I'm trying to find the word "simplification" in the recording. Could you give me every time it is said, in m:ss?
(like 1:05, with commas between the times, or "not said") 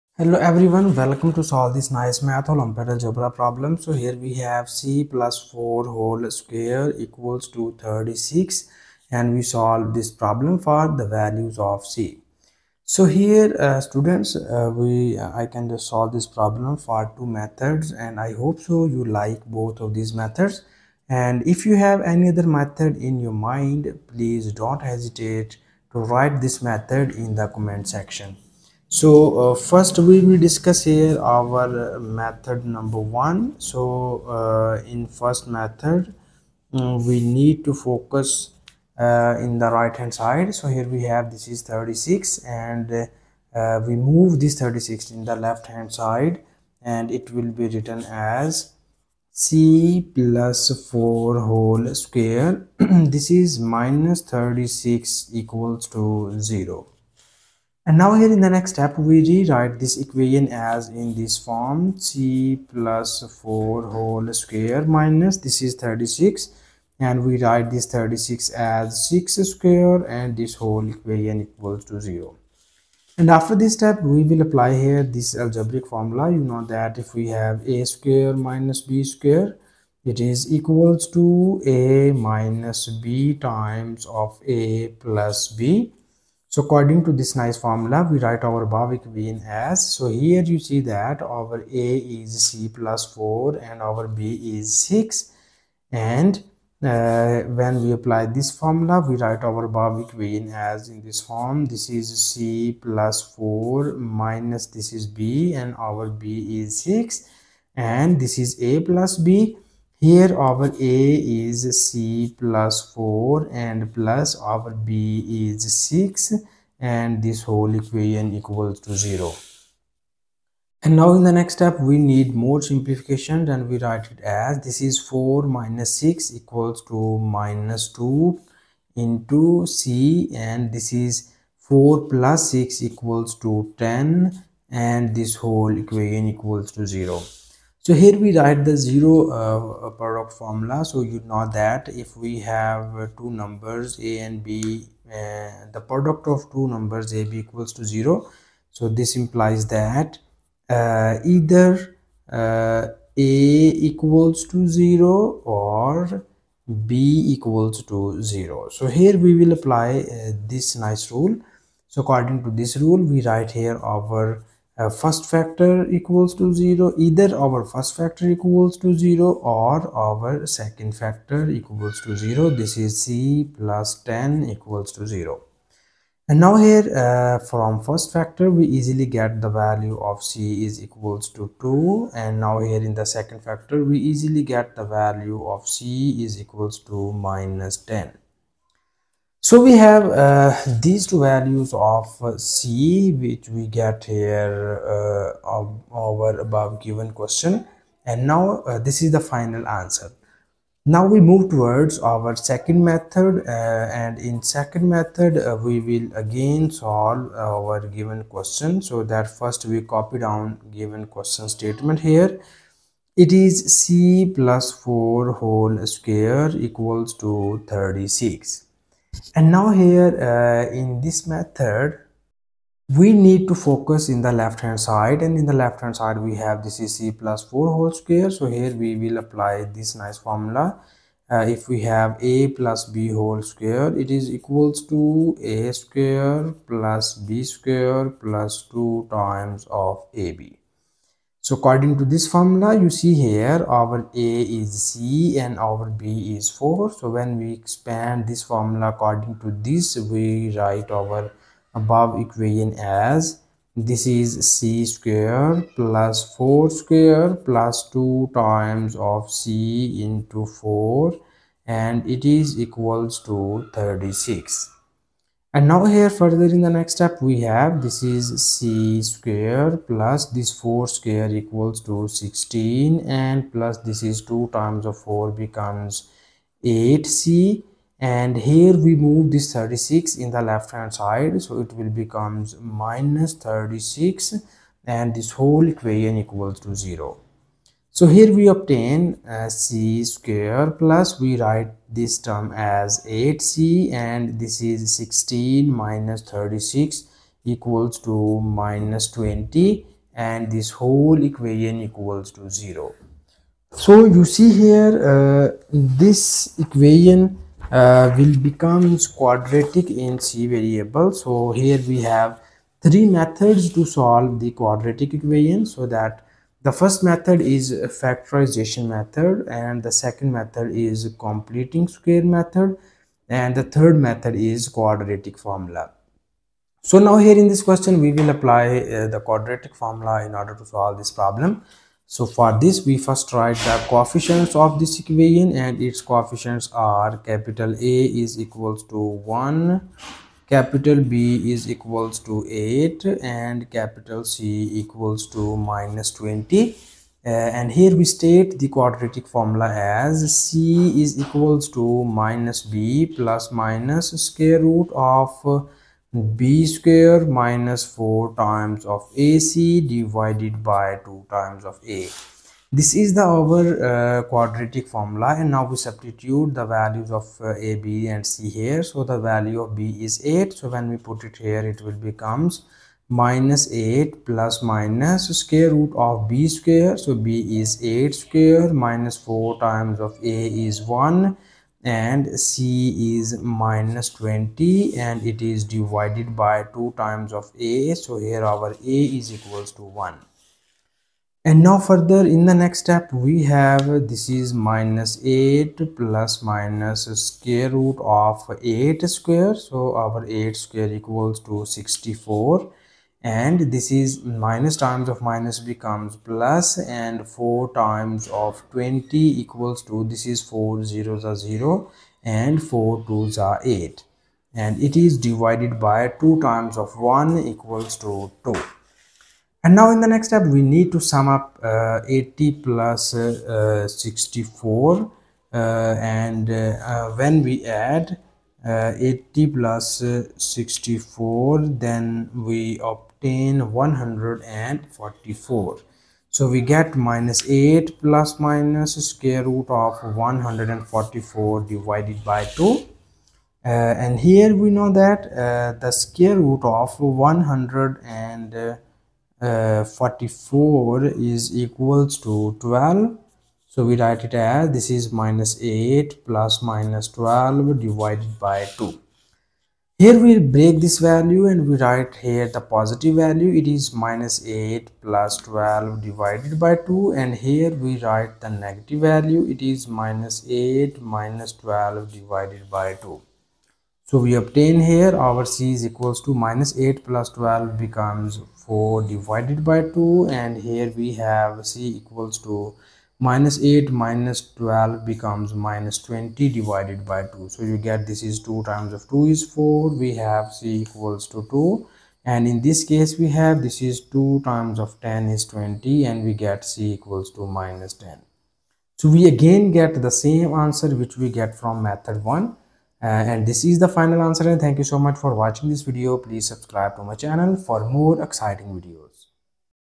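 2:02.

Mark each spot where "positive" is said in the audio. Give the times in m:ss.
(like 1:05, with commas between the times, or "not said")
7:42.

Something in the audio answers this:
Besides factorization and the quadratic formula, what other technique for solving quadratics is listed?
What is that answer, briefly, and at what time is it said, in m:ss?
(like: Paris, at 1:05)
completing square method, at 5:21.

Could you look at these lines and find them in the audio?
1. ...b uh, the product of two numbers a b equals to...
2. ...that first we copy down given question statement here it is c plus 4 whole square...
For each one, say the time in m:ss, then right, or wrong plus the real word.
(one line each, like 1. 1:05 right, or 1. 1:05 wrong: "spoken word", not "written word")
1. 2:24 right
2. 3:29 right.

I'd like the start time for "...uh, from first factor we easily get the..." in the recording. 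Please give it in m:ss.
2:57.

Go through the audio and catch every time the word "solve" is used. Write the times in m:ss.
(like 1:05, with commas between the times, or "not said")
0:01, 0:09, 0:15, 3:26, 5:13, 5:30.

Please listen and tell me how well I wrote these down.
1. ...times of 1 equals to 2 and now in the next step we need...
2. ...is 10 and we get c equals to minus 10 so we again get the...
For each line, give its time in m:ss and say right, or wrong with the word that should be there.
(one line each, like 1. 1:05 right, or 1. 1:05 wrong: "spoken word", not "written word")
1. 6:56 right
2. 8:15 wrong: "20", not "10".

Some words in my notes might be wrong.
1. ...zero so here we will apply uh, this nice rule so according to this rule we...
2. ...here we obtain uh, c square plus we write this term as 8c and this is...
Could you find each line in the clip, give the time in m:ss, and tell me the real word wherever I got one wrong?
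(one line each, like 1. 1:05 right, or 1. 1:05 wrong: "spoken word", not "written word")
1. 2:38 right
2. 4:48 right.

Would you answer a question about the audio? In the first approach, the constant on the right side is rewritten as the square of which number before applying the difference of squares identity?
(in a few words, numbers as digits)
6.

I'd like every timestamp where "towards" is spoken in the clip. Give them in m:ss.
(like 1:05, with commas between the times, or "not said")
3:21.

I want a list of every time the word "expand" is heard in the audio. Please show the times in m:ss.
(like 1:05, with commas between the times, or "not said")
4:07.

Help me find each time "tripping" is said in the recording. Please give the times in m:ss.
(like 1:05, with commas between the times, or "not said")
not said.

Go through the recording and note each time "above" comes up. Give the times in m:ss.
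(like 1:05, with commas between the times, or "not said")
3:16, 4:11.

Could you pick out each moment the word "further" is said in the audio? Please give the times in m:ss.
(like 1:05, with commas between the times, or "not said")
4:26, 6:31.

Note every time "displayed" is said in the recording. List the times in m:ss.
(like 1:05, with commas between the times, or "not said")
not said.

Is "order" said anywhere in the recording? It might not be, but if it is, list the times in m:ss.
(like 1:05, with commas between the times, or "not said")
5:30.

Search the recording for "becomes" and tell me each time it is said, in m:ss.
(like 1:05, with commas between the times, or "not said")
4:35, 4:41, 5:08, 6:12, 6:45, 7:57, 8:05.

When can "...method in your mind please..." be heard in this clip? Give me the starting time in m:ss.
0:22.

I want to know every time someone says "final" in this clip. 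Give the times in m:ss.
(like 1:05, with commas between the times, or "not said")
3:19, 8:23.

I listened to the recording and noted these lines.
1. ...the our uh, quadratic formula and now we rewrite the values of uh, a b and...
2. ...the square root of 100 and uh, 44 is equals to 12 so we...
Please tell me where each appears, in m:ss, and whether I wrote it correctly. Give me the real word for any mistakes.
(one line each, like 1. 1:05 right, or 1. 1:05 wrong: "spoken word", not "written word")
1. 6:03 wrong: "substitute", not "rewrite"
2. 7:25 right.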